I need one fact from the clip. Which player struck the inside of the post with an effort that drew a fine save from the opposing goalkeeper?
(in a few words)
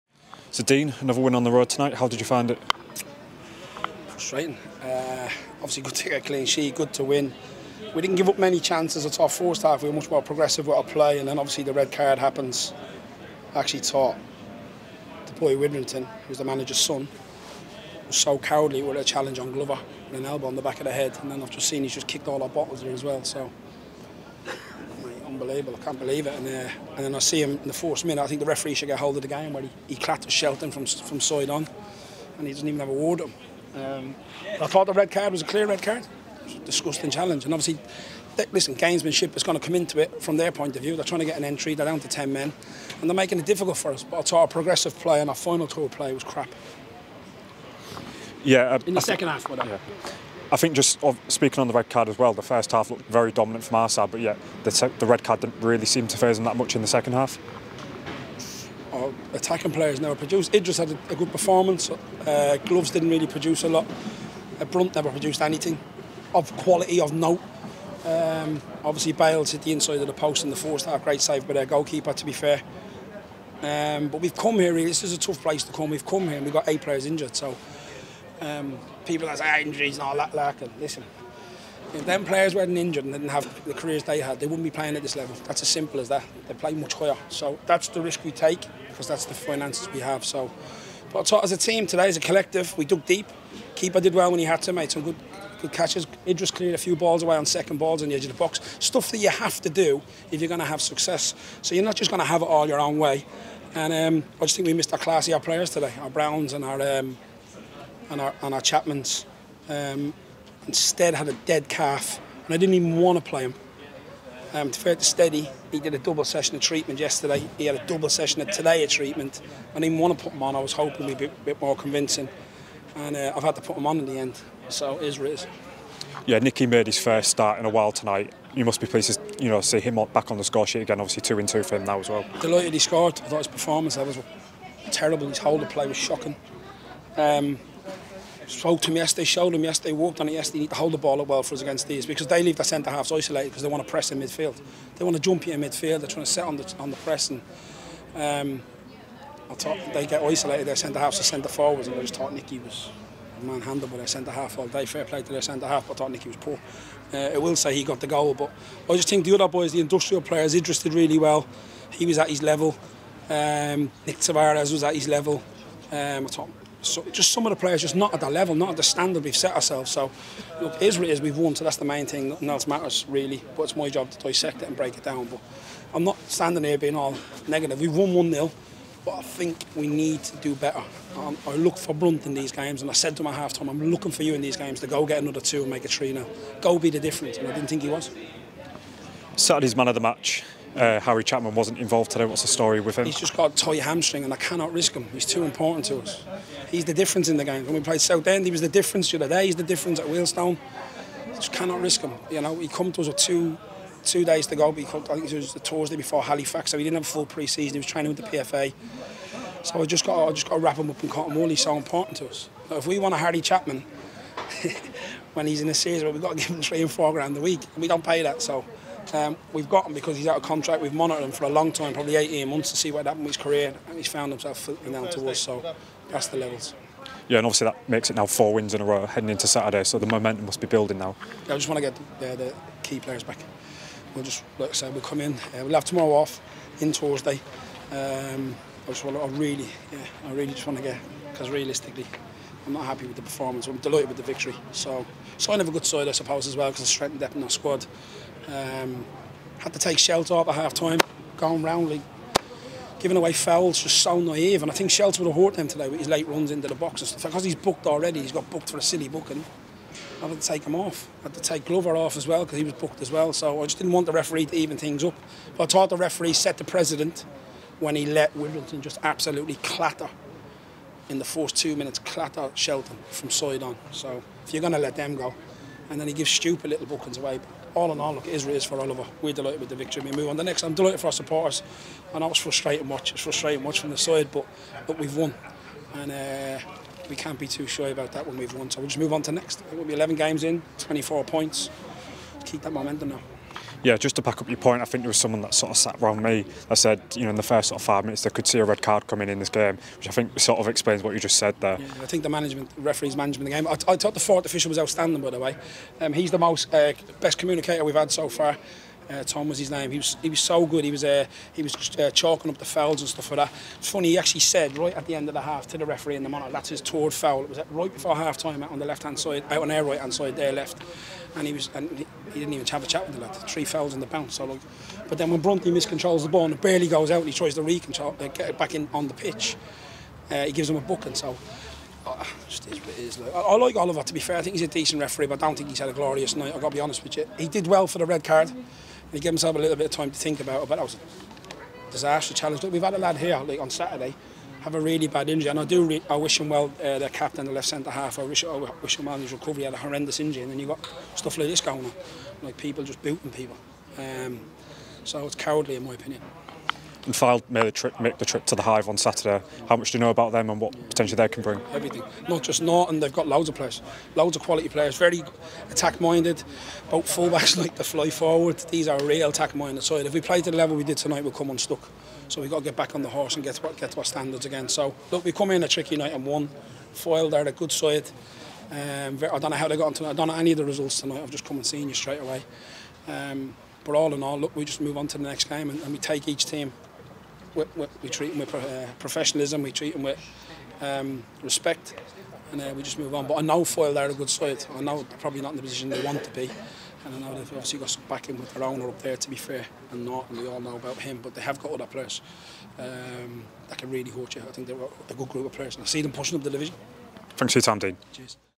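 Bales.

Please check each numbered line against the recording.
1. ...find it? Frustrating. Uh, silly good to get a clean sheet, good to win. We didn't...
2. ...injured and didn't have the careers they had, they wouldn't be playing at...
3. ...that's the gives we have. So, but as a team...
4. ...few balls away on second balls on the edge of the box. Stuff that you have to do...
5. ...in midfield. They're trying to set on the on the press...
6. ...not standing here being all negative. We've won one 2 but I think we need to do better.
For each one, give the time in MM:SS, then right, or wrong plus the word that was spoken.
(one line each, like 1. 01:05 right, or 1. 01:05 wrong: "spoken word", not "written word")
1. 00:02 wrong: "obviously", not "silly"
2. 01:22 right
3. 01:29 wrong: "finances", not "gives"
4. 01:36 right
5. 02:25 right
6. 02:56 wrong: "0", not "2".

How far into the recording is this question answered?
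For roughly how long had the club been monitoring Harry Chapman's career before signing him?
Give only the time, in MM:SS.
03:42.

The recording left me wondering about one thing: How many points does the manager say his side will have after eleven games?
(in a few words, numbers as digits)
24.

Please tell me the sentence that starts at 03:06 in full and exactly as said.
Go be the difference, and I didn't think he was.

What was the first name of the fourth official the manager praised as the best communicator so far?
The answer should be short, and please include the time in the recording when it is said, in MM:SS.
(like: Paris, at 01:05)
Tom, at 05:09.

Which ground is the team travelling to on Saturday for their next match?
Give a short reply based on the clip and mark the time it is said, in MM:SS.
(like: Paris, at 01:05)
The Hive, at 05:58.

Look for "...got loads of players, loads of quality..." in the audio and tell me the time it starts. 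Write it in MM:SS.
06:03.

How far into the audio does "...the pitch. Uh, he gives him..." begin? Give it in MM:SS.
05:29.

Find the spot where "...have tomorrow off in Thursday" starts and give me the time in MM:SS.
03:55.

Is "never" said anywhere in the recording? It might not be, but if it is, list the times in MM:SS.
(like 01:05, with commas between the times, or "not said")
01:00, 01:04.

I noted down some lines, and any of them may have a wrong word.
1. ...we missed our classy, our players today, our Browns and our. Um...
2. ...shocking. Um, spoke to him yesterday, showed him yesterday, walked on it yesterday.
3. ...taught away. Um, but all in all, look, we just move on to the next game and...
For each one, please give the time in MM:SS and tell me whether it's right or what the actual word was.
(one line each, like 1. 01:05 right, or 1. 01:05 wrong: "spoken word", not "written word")
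1. 01:44 right
2. 02:15 right
3. 06:21 wrong: "straight", not "taught".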